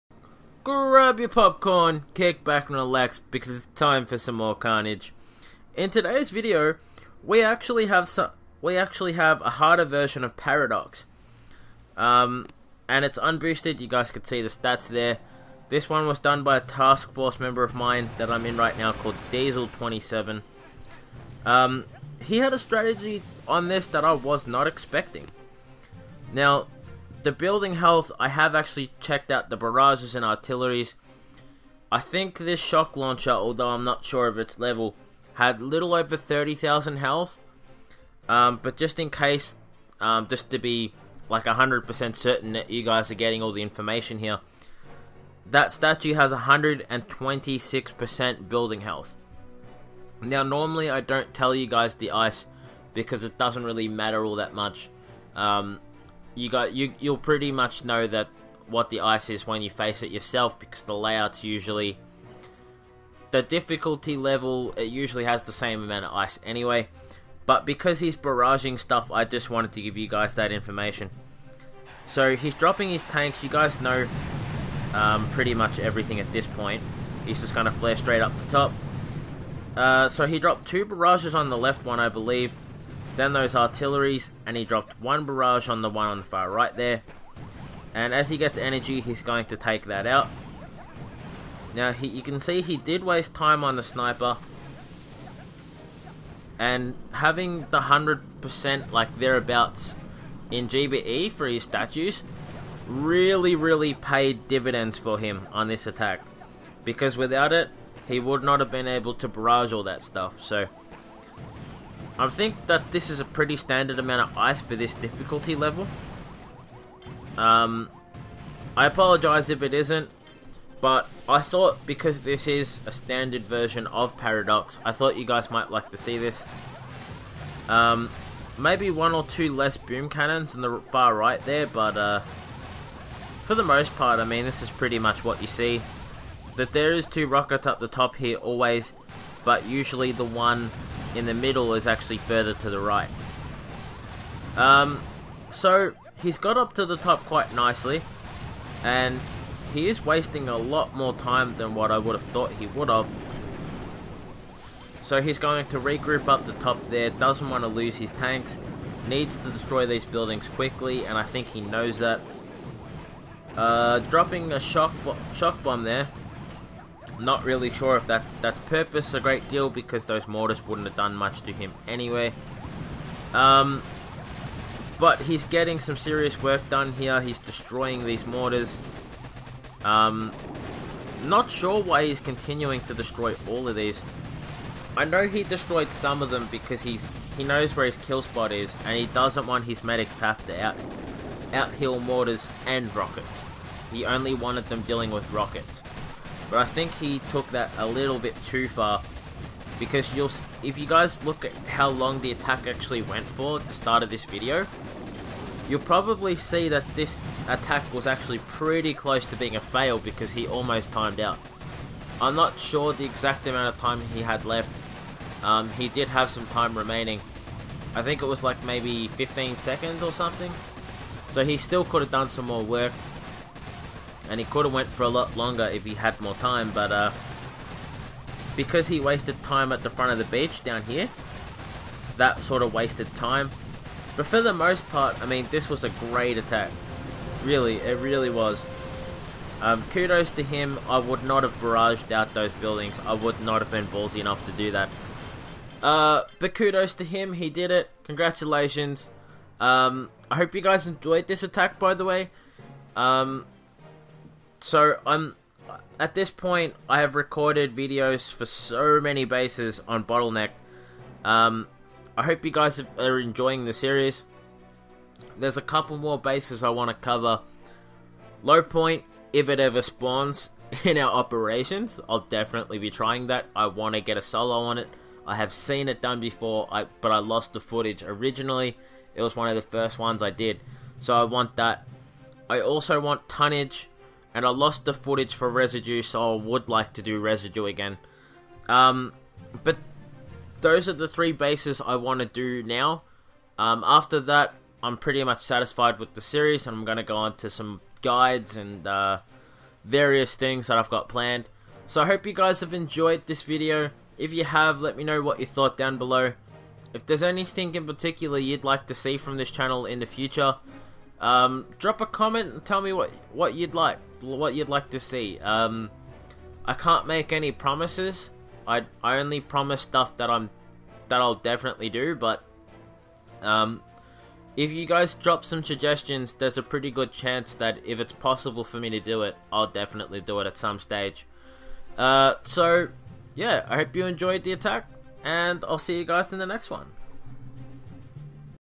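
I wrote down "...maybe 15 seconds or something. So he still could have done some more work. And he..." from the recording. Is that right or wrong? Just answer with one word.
right.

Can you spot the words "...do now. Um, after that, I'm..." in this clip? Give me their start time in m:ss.
4:52.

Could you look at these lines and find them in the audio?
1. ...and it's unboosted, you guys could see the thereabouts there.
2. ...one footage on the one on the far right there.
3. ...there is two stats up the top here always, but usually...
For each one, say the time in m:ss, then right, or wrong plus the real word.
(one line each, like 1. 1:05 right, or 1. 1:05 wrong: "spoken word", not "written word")
1. 0:12 wrong: "stats", not "thereabouts"
2. 1:25 wrong: "barrage", not "footage"
3. 2:16 wrong: "rockets", not "stats".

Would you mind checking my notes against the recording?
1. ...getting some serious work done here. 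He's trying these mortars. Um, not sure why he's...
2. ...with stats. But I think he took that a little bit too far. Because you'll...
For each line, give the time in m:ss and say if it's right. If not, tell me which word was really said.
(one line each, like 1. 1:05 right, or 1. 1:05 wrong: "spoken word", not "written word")
1. 2:55 wrong: "destroying", not "trying"
2. 3:15 wrong: "rockets", not "stats".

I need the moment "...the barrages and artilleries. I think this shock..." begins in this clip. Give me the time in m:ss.
0:29.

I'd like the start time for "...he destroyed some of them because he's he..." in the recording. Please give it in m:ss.
3:05.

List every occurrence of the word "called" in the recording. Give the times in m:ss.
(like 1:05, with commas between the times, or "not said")
0:18.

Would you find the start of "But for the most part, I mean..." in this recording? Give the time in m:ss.
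3:54.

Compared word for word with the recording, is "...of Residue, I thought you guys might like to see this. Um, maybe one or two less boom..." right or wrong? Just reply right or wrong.
wrong.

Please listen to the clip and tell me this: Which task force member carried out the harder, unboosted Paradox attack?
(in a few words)
Diesel27.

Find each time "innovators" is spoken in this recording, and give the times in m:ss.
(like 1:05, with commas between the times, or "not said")
not said.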